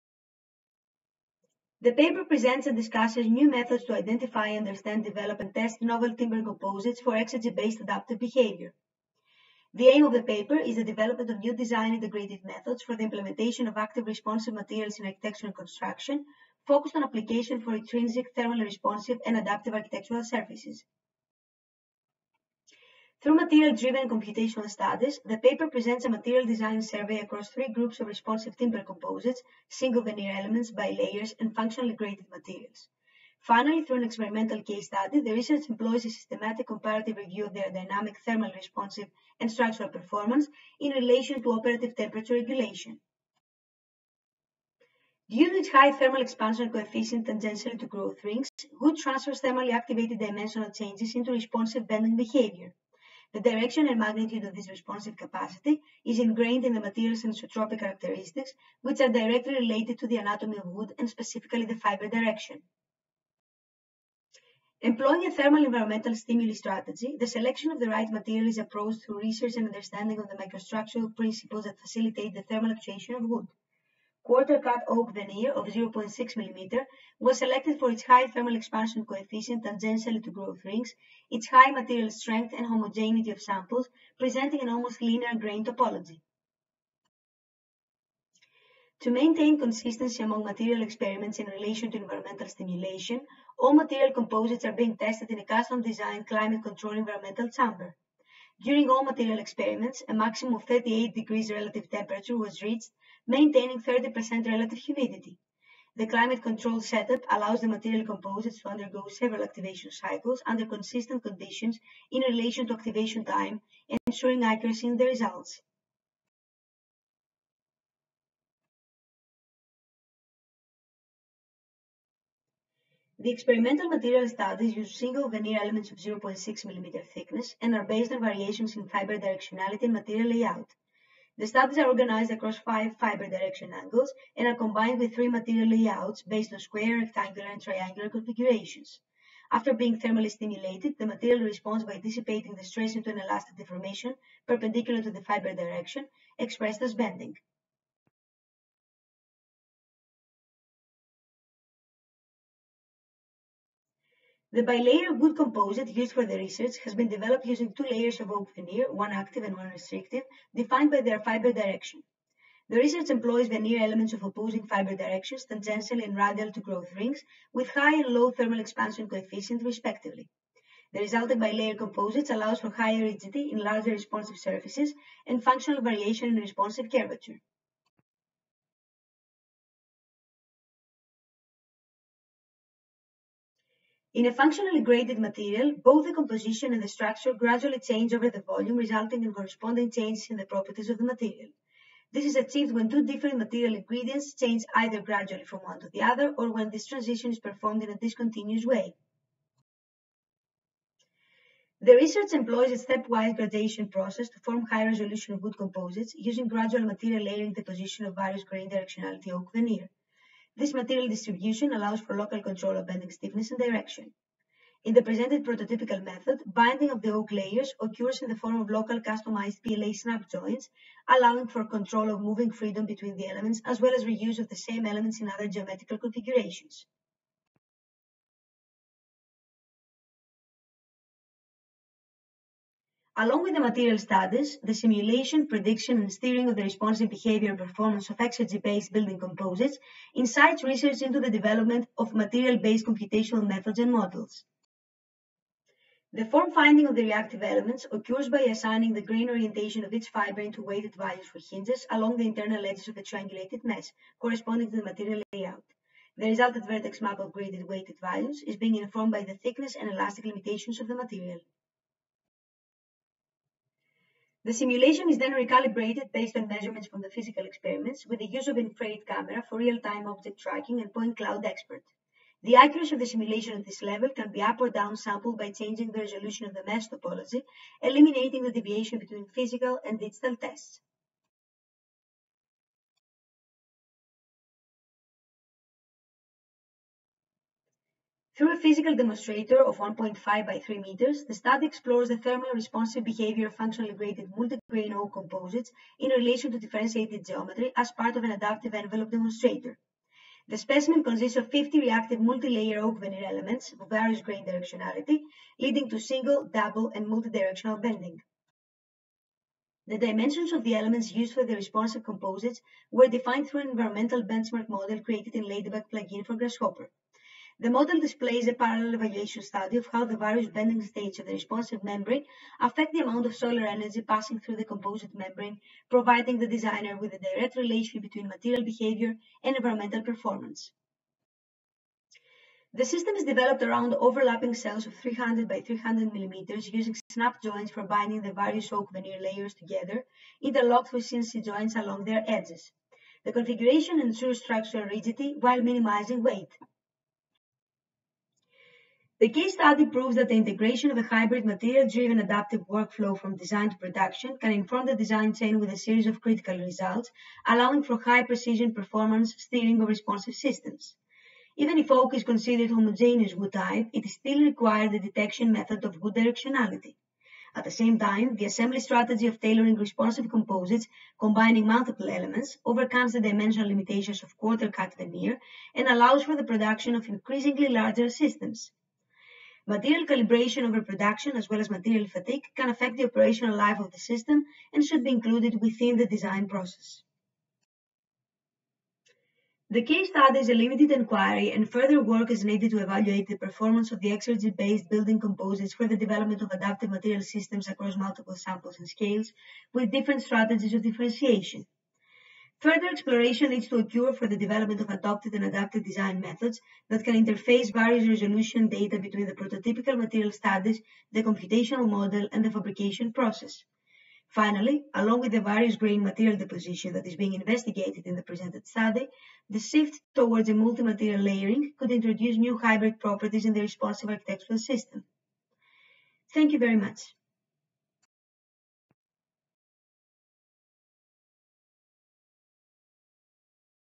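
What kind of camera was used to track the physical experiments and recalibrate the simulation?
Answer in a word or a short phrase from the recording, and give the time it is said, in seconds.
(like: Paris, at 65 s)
Infrared camera, at 268 s.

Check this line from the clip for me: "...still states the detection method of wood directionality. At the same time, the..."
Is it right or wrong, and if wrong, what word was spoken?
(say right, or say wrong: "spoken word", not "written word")
wrong: "requires", not "states".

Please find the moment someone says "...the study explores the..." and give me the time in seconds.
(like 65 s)
291 s.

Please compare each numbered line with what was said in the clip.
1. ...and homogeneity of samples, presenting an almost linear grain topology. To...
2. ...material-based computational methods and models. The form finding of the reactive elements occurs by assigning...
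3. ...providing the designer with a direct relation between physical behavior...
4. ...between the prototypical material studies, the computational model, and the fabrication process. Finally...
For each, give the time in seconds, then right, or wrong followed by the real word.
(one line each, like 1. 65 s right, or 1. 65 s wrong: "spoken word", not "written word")
1. 82 s right
2. 242 s right
3. 325 s wrong: "material", not "physical"
4. 408 s right.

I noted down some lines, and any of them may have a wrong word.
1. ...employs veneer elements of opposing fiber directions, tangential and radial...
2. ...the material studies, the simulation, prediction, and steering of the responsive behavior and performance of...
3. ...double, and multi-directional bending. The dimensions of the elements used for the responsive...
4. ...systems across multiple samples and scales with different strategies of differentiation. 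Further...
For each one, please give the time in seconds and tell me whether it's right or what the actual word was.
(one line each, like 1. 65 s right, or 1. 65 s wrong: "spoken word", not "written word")
1. 163 s right
2. 233 s right
3. 306 s right
4. 397 s right.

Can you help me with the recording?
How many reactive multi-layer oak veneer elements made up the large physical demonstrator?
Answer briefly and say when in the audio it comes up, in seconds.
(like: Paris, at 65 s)
50, at 301 s.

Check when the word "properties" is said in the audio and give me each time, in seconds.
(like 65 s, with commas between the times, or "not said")
190 s, 422 s.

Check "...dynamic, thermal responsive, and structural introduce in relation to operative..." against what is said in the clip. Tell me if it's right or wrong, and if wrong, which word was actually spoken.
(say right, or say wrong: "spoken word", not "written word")
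wrong: "performance", not "introduce".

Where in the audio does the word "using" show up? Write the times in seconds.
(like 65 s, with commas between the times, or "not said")
157 s, 206 s, 336 s.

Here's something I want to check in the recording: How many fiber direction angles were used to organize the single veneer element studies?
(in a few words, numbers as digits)
5.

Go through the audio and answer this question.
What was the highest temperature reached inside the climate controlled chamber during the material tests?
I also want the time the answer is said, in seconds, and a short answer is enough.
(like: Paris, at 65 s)
38 degrees, at 100 s.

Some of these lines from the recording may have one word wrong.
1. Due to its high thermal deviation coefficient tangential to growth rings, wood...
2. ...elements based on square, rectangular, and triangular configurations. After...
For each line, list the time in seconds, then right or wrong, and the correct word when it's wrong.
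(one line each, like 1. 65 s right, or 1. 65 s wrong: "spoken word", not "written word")
1. 45 s wrong: "expansion", not "deviation"
2. 135 s wrong: "layouts", not "elements".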